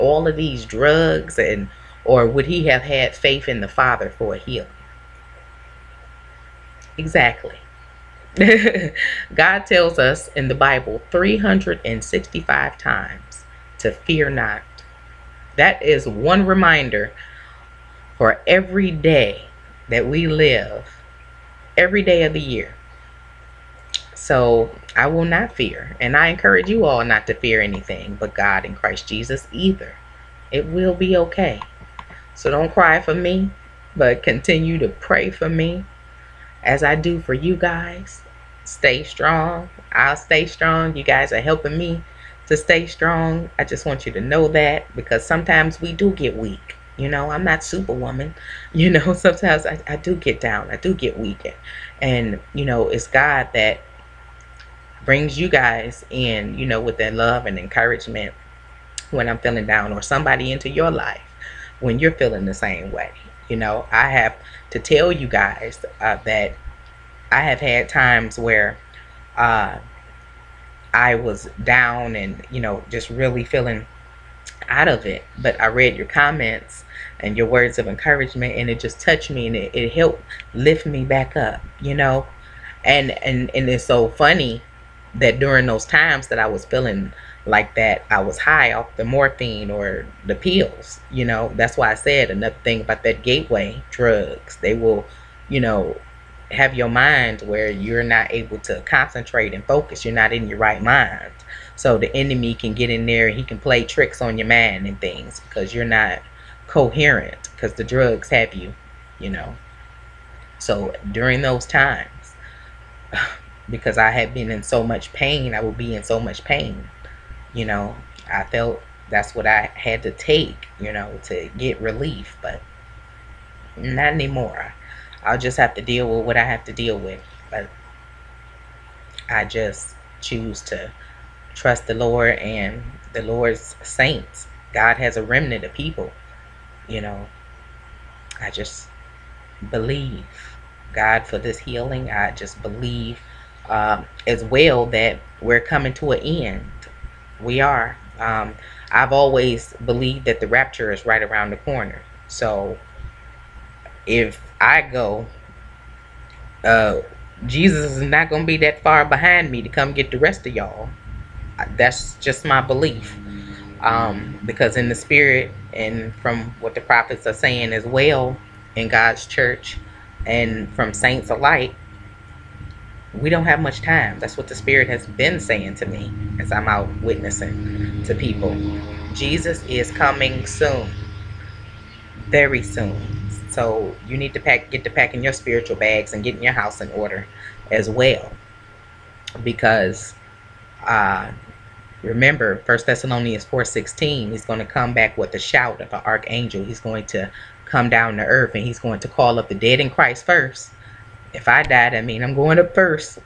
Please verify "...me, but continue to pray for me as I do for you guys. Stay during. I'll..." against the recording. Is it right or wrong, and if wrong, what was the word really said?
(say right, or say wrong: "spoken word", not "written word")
wrong: "strong", not "during".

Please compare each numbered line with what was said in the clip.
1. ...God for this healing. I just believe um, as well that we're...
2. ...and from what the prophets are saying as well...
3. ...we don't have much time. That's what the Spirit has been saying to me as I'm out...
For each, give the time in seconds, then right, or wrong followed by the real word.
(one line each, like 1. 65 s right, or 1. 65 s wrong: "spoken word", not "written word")
1. 140 s right
2. 165 s right
3. 173 s right.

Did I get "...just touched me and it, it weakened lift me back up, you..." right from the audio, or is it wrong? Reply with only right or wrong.
wrong.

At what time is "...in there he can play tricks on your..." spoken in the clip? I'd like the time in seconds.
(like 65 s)
102 s.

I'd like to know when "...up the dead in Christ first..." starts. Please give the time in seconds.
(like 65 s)
199 s.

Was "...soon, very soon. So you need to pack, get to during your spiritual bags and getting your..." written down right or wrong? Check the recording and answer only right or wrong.
wrong.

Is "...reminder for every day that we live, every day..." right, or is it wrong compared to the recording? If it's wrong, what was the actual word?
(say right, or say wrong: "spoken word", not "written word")
right.